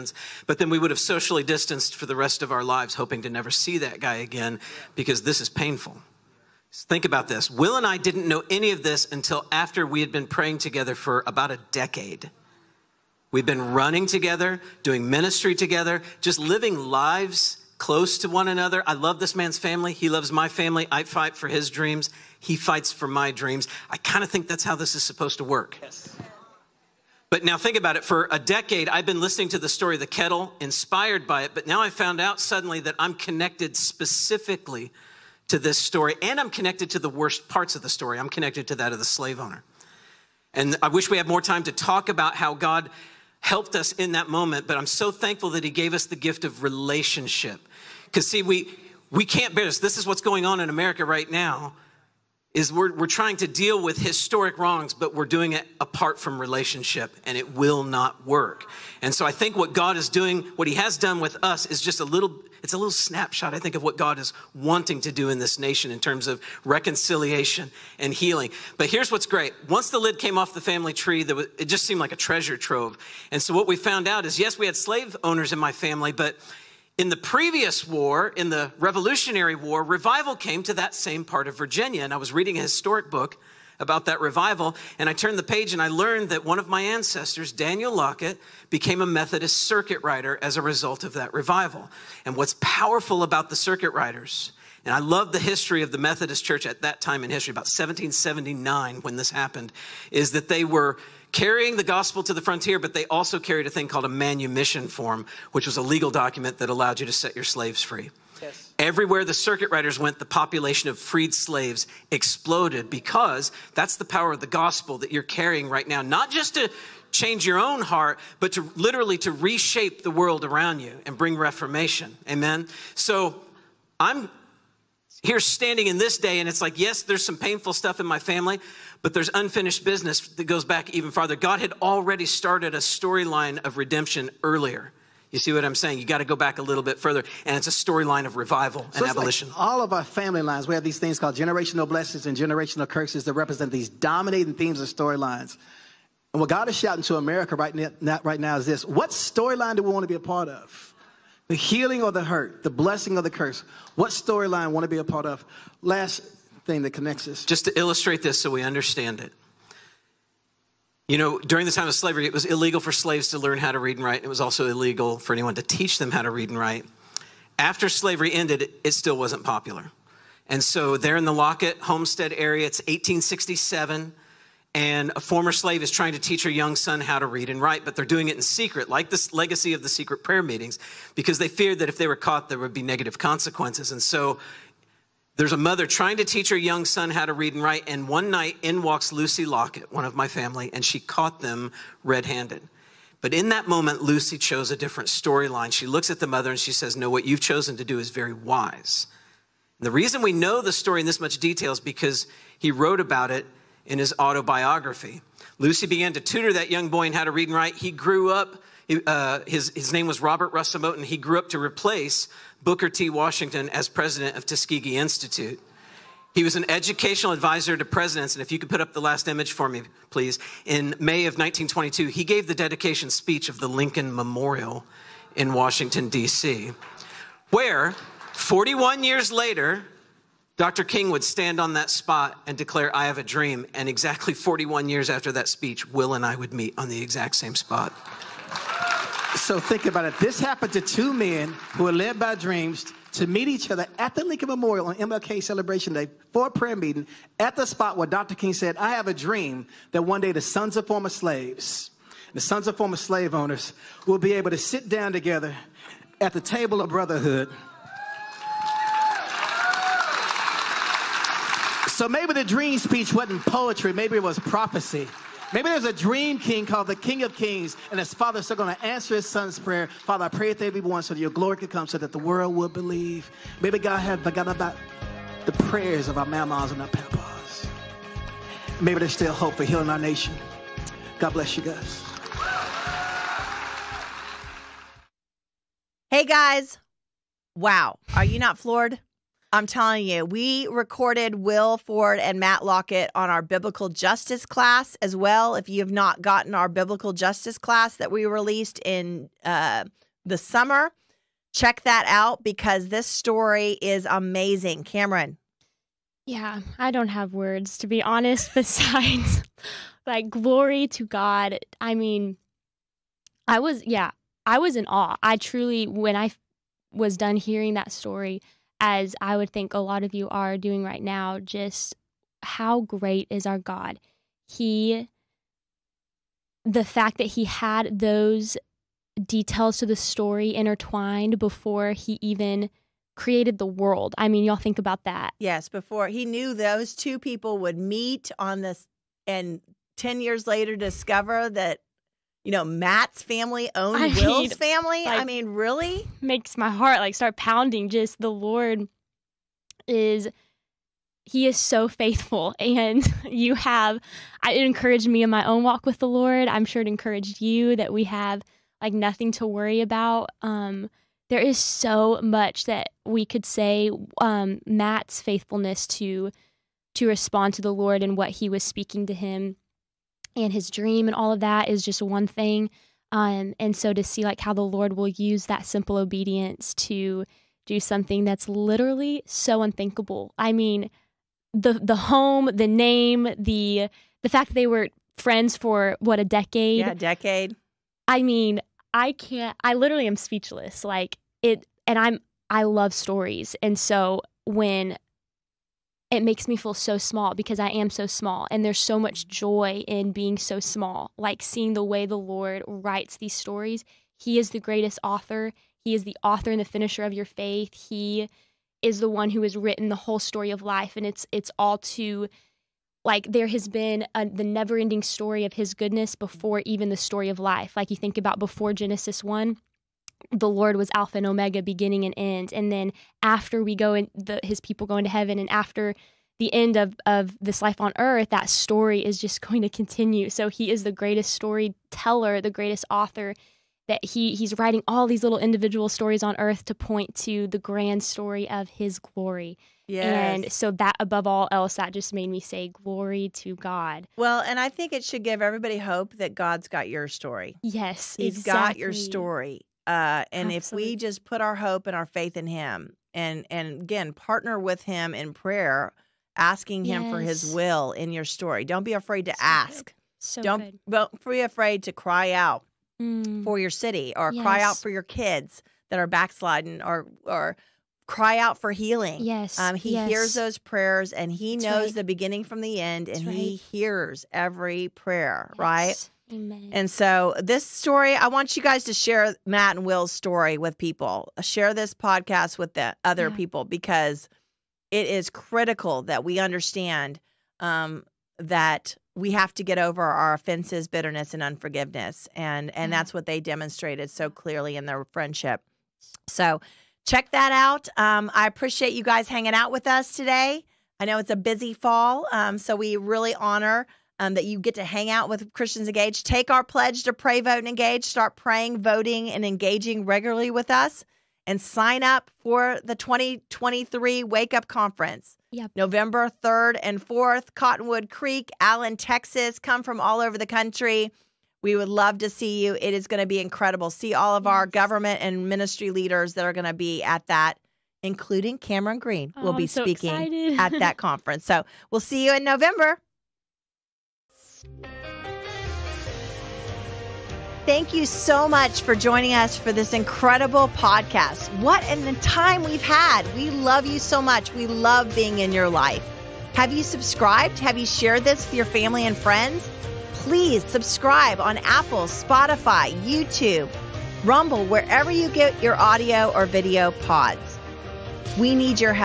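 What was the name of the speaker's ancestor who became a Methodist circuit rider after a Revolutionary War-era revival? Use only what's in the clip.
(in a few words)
Daniel Lockett.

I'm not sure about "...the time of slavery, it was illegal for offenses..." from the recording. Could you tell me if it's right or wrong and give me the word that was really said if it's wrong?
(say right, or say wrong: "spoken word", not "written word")
wrong: "slaves", not "offenses".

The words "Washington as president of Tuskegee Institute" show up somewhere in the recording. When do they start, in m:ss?
3:33.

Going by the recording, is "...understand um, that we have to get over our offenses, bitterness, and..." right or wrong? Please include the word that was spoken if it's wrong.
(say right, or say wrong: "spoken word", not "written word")
right.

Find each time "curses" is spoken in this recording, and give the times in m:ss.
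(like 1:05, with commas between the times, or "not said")
2:22, 2:33.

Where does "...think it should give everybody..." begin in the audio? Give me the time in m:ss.
7:24.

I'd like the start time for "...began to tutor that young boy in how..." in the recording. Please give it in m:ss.
3:25.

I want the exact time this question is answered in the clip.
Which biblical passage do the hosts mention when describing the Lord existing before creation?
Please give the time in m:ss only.
6:58.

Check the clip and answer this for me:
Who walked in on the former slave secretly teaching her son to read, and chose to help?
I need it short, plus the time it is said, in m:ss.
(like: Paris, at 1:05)
Lucy Lockett, at 3:09.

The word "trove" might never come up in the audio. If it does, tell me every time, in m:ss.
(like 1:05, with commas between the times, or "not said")
1:12.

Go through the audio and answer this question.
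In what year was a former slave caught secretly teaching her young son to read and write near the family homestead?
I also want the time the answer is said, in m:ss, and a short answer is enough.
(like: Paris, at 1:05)
1867, at 2:52.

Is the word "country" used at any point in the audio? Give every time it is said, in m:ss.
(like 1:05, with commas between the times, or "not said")
8:40.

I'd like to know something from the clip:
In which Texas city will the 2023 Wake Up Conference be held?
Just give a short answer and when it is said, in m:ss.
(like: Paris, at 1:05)
Allen, at 8:38.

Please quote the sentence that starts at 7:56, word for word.
And so, this story, I want you guys to share Matt and Will's story with people.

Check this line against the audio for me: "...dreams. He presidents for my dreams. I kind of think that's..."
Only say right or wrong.
wrong.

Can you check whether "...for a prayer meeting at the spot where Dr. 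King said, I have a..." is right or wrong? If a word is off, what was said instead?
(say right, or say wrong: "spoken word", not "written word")
right.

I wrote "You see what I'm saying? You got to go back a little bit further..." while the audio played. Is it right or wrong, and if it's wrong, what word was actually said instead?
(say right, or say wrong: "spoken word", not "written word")
right.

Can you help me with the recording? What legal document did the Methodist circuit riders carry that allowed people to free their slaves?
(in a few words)
manumission form.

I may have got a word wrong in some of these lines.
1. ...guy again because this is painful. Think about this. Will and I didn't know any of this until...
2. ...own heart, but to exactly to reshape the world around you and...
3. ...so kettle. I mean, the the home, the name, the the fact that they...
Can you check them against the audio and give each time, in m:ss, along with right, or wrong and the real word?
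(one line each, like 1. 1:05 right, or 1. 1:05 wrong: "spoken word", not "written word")
1. 0:03 right
2. 1:57 wrong: "literally", not "exactly"
3. 6:19 wrong: "unthinkable", not "kettle".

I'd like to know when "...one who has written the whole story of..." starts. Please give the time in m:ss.
6:49.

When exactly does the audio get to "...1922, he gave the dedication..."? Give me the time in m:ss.
3:41.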